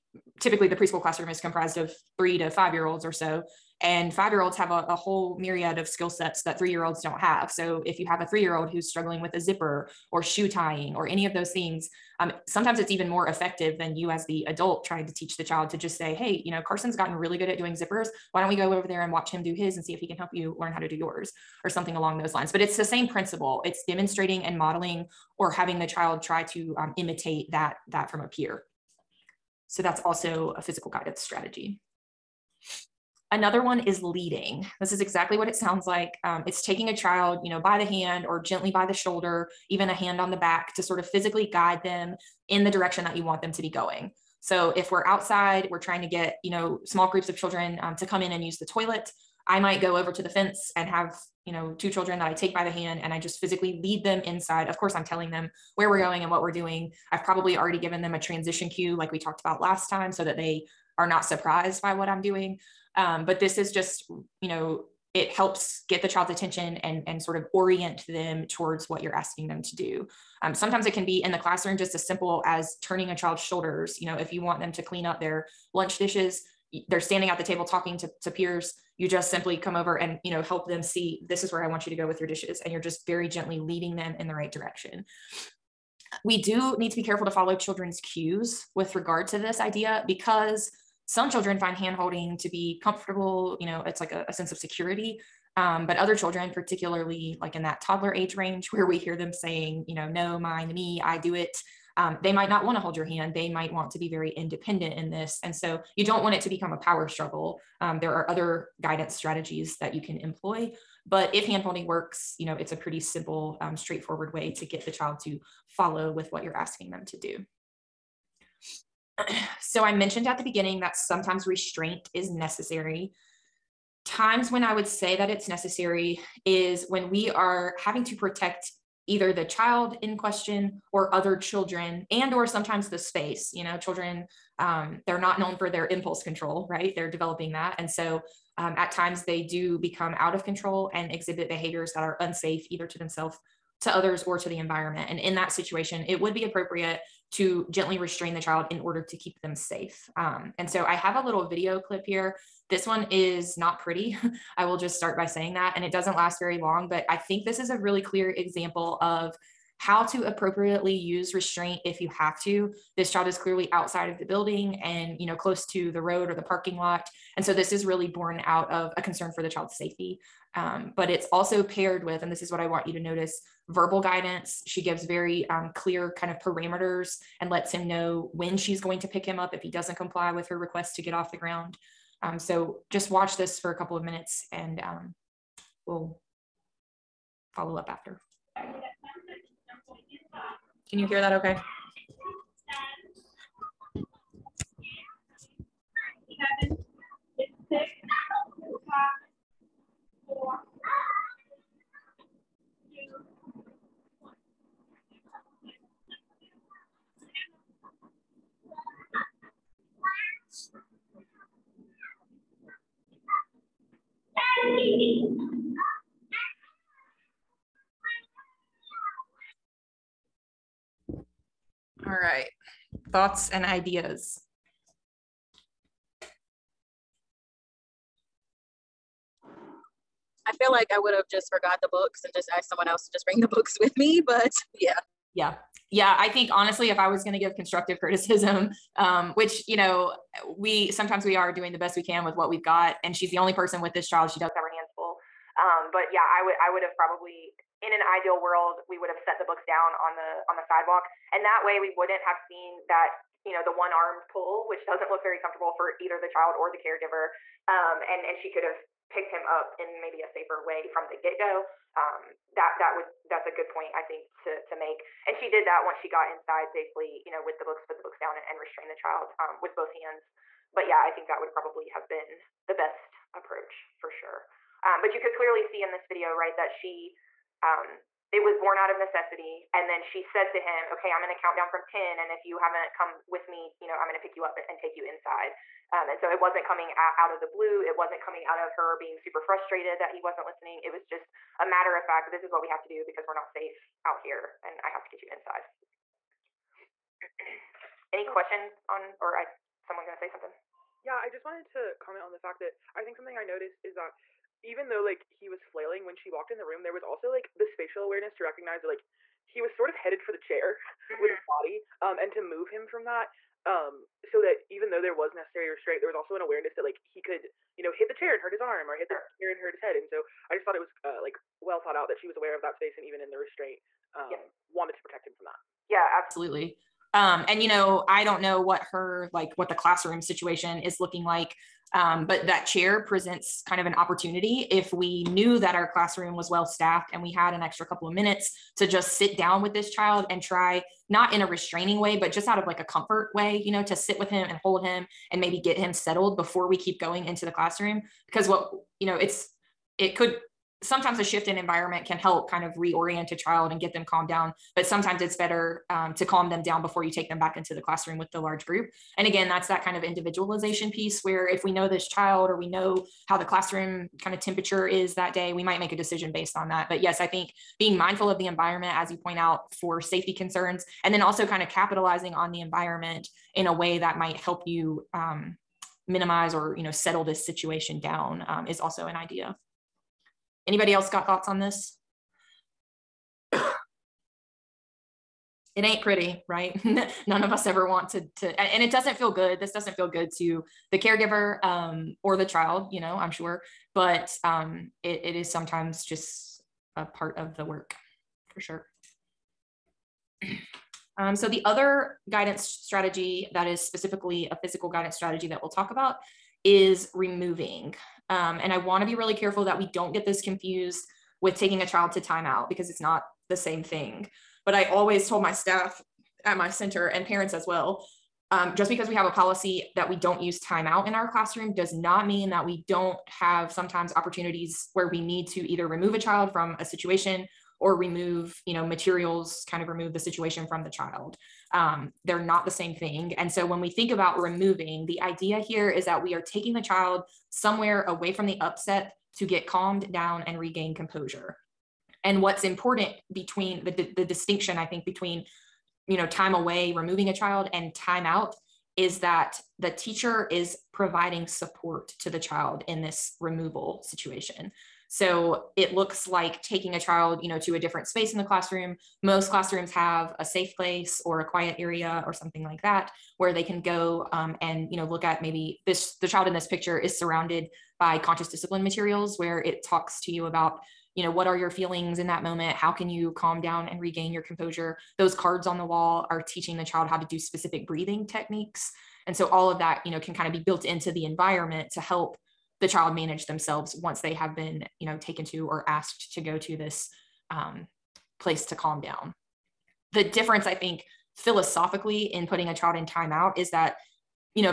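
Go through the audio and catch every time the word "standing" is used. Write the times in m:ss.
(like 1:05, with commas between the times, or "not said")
1:16.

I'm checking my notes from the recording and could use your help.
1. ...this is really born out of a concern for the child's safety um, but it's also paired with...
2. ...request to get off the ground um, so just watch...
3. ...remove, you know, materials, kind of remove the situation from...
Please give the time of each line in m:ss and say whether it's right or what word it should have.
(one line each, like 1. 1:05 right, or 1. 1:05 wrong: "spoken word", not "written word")
1. 2:47 right
2. 3:00 right
3. 7:07 right.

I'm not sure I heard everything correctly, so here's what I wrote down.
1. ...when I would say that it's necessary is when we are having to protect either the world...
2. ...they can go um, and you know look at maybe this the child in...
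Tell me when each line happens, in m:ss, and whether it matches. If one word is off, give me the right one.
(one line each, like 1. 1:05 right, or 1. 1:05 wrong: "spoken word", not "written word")
1. 2:04 wrong: "child", not "world"
2. 7:43 right.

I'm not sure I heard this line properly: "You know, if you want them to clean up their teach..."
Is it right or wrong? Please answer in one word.
wrong.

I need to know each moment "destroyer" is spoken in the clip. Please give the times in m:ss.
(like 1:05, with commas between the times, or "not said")
not said.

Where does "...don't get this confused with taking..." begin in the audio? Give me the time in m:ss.
6:49.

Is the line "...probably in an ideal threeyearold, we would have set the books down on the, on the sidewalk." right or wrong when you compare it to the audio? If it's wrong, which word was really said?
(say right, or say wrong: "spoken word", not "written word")
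wrong: "world", not "threeyearold".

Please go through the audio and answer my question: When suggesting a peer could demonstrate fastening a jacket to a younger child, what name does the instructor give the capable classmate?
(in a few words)
Carson.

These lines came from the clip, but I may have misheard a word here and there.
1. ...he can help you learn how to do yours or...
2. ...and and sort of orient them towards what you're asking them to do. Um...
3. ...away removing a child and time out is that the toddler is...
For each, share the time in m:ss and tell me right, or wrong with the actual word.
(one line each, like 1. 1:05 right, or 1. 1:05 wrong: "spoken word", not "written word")
1. 0:19 right
2. 1:06 right
3. 7:26 wrong: "teacher", not "toddler".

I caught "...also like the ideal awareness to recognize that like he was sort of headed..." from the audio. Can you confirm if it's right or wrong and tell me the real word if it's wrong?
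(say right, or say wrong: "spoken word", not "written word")
wrong: "spatial", not "ideal".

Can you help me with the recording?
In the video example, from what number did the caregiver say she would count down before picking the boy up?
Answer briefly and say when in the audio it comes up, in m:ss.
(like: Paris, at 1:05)
10, at 4:41.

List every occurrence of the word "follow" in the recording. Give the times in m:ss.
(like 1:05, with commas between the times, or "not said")
1:27, 1:55, 3:07.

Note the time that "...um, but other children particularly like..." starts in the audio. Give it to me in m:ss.
1:35.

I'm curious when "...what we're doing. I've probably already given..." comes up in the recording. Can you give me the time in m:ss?
0:56.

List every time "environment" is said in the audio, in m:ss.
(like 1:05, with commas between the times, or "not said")
2:24, 5:51, 6:08, 6:12, 8:01.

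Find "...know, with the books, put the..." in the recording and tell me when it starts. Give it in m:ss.
4:27.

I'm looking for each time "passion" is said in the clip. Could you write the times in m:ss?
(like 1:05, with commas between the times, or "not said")
not said.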